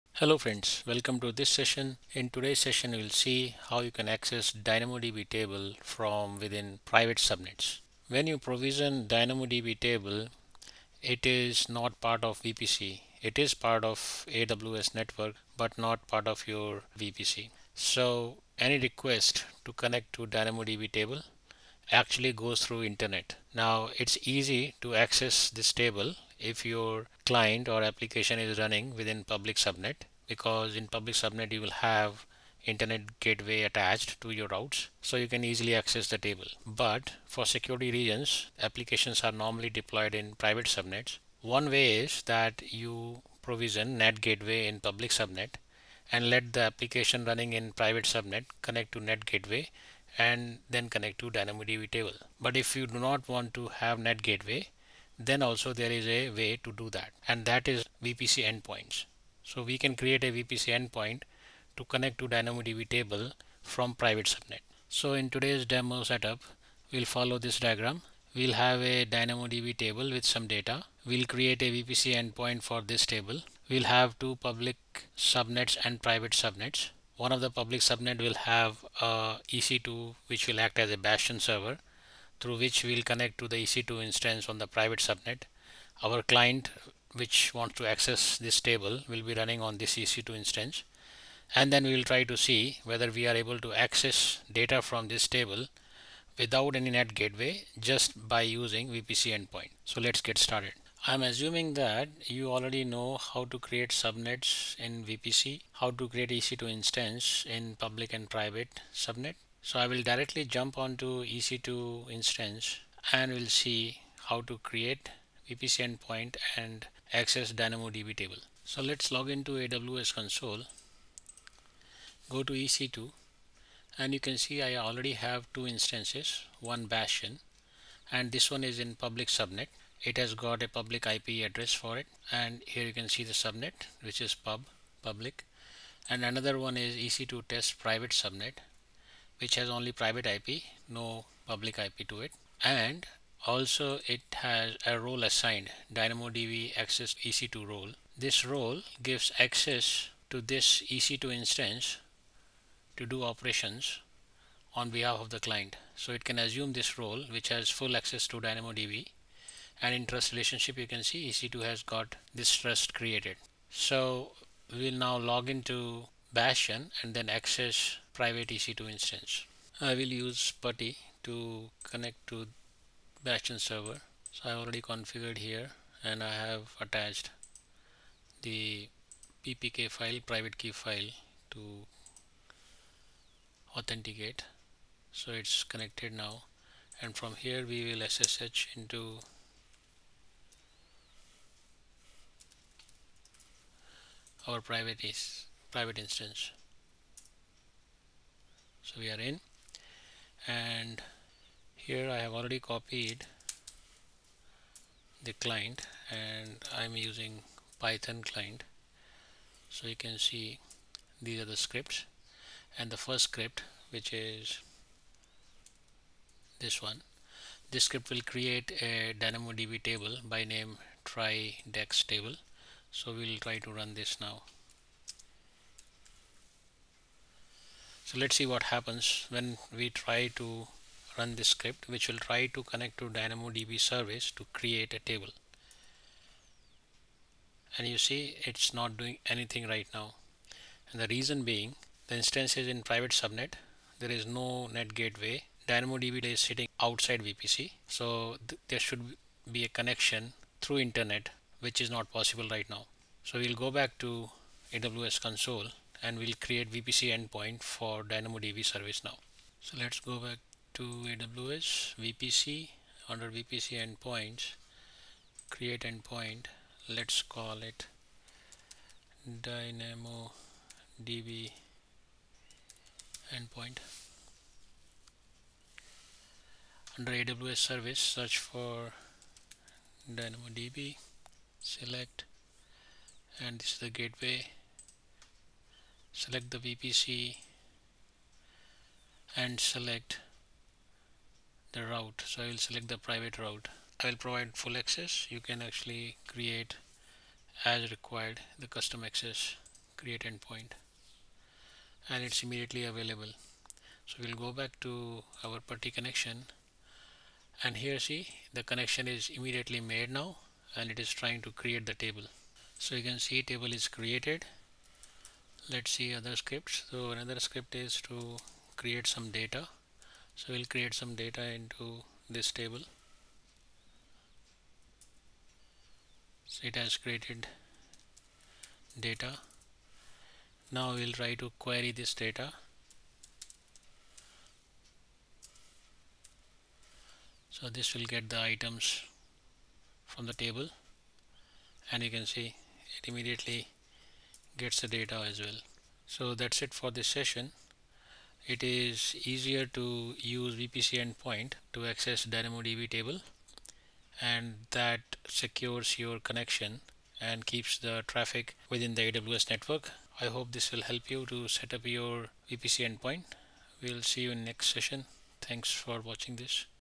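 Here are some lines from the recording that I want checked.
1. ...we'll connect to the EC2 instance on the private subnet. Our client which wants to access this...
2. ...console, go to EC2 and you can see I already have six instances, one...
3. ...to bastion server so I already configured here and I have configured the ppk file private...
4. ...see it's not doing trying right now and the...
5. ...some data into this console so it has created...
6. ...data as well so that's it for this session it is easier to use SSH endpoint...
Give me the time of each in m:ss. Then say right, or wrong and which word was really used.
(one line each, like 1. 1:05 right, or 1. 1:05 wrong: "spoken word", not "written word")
1. 1:22 right
2. 2:00 wrong: "two", not "six"
3. 2:52 wrong: "attached", not "configured"
4. 3:57 wrong: "anything", not "trying"
5. 5:20 wrong: "table", not "console"
6. 5:44 wrong: "VPC", not "SSH".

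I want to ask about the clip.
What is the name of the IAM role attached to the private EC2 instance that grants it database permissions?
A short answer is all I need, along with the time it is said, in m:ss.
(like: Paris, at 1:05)
DynamoDB access EC2 role, at 2:25.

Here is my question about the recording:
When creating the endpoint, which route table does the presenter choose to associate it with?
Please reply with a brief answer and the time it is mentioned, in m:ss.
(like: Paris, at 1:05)
private route, at 4:52.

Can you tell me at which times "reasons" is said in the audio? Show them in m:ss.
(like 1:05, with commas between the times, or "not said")
0:37, 4:01.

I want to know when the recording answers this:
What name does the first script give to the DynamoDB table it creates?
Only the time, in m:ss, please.
3:41.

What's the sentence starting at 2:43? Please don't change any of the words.
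So we'll now log into Bastion and then access private EC2 instance.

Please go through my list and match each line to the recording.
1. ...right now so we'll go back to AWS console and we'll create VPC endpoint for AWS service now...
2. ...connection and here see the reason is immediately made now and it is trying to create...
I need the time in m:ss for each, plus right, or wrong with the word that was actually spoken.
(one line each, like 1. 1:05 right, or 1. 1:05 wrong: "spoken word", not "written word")
1. 4:12 wrong: "DynamoDB", not "AWS"
2. 5:05 wrong: "connection", not "reason".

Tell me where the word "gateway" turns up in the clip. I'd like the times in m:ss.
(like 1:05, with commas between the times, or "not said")
0:33, 0:44, 0:49, 0:54, 1:37, 4:04, 4:43.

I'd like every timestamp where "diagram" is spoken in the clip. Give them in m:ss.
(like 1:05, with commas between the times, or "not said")
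1:07.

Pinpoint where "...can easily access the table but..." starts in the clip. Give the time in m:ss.
0:35.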